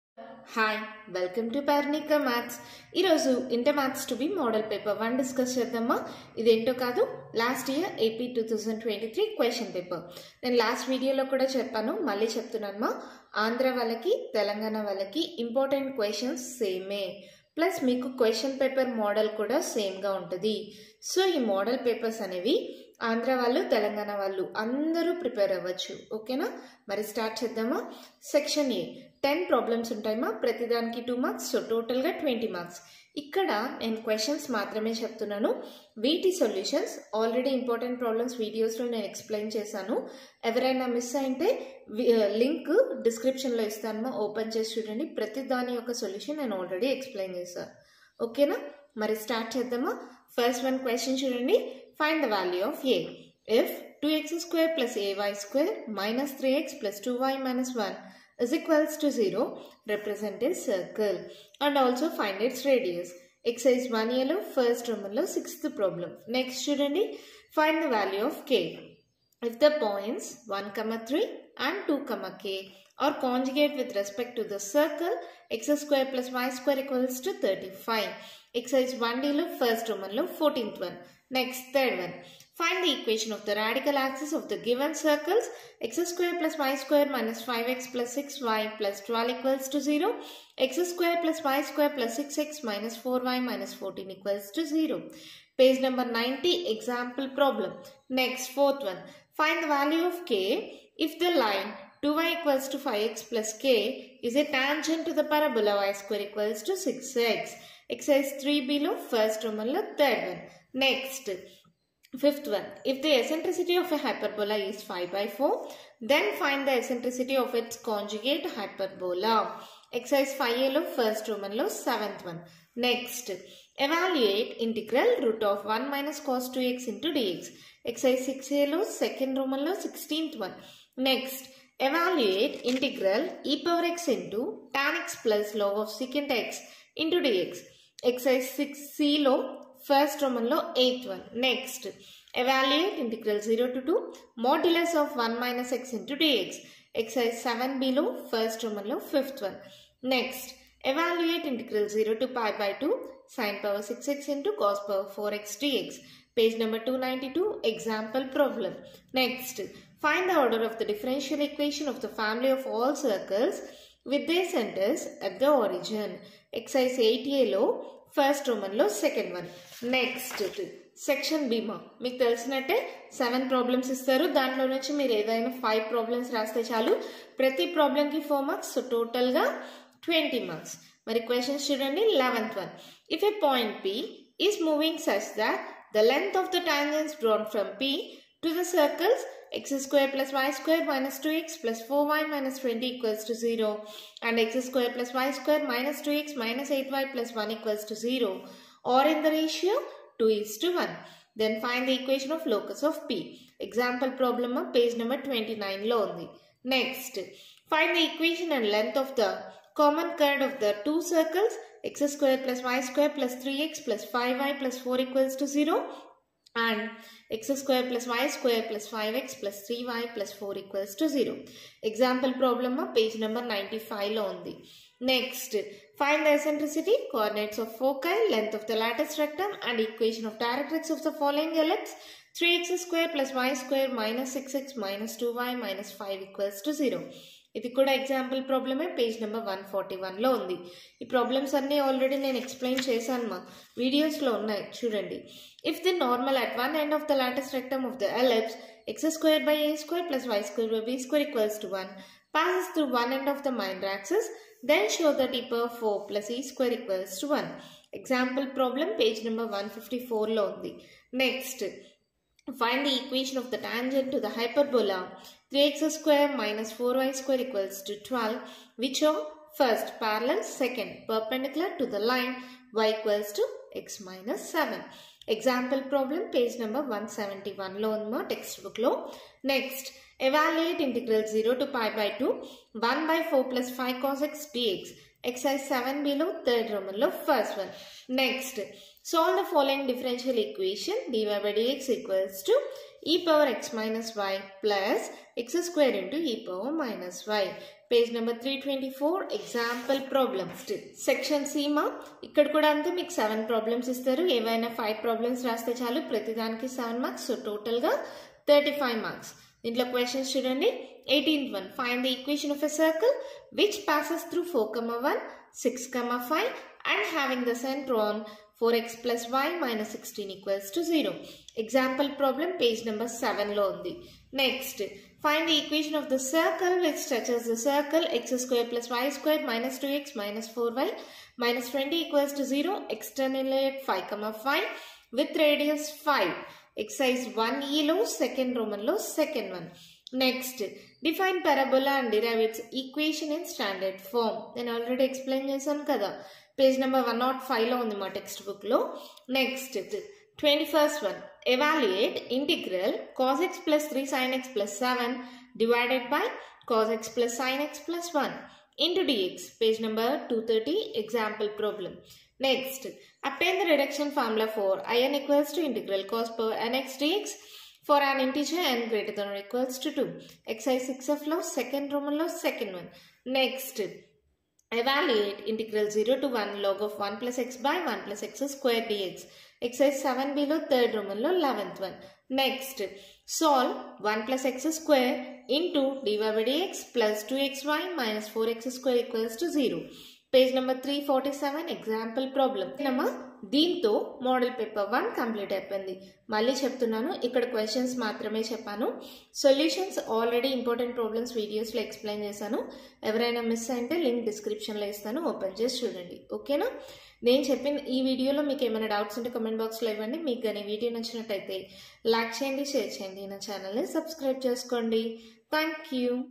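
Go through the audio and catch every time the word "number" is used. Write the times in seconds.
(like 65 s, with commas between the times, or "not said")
95 s, 156 s, 204 s, 223 s, 276 s, 322 s, 346 s, 359 s.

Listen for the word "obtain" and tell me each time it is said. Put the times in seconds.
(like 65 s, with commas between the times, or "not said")
363 s.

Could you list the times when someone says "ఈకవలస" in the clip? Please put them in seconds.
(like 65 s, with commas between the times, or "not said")
251 s, 256 s, 291 s.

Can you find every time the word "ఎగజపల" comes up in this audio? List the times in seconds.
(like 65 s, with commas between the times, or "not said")
237 s, 257 s, 299 s, 391 s.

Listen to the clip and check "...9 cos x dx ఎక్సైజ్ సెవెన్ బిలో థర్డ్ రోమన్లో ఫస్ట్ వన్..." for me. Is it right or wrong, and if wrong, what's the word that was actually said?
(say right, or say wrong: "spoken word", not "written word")
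wrong: "5", not "9".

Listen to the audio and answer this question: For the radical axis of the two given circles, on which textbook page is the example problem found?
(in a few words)
90.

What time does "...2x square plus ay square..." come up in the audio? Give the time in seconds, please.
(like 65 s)
54 s.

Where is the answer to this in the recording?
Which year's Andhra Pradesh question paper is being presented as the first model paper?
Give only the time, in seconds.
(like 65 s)
8 s.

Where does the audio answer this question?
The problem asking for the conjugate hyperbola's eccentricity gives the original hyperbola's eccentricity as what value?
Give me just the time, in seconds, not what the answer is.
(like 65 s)
114 s.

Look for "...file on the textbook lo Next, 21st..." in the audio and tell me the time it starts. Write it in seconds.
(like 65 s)
347 s.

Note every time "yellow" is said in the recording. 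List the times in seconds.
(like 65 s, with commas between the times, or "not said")
64 s, 79 s, 167 s.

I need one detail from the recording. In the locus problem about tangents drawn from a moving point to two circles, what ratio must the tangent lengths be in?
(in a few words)
2:1.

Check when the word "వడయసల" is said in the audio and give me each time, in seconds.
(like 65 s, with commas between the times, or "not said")
38 s, 243 s, 401 s.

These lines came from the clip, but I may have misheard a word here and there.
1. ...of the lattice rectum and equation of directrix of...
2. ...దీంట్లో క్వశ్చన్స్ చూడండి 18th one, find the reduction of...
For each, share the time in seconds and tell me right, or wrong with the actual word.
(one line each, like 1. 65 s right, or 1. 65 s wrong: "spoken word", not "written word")
1. 228 s right
2. 309 s wrong: "equation", not "reduction".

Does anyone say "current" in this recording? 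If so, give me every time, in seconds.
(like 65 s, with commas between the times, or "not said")
210 s.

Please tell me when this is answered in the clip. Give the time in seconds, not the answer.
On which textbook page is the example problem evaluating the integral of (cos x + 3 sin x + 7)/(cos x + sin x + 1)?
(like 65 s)
359 s.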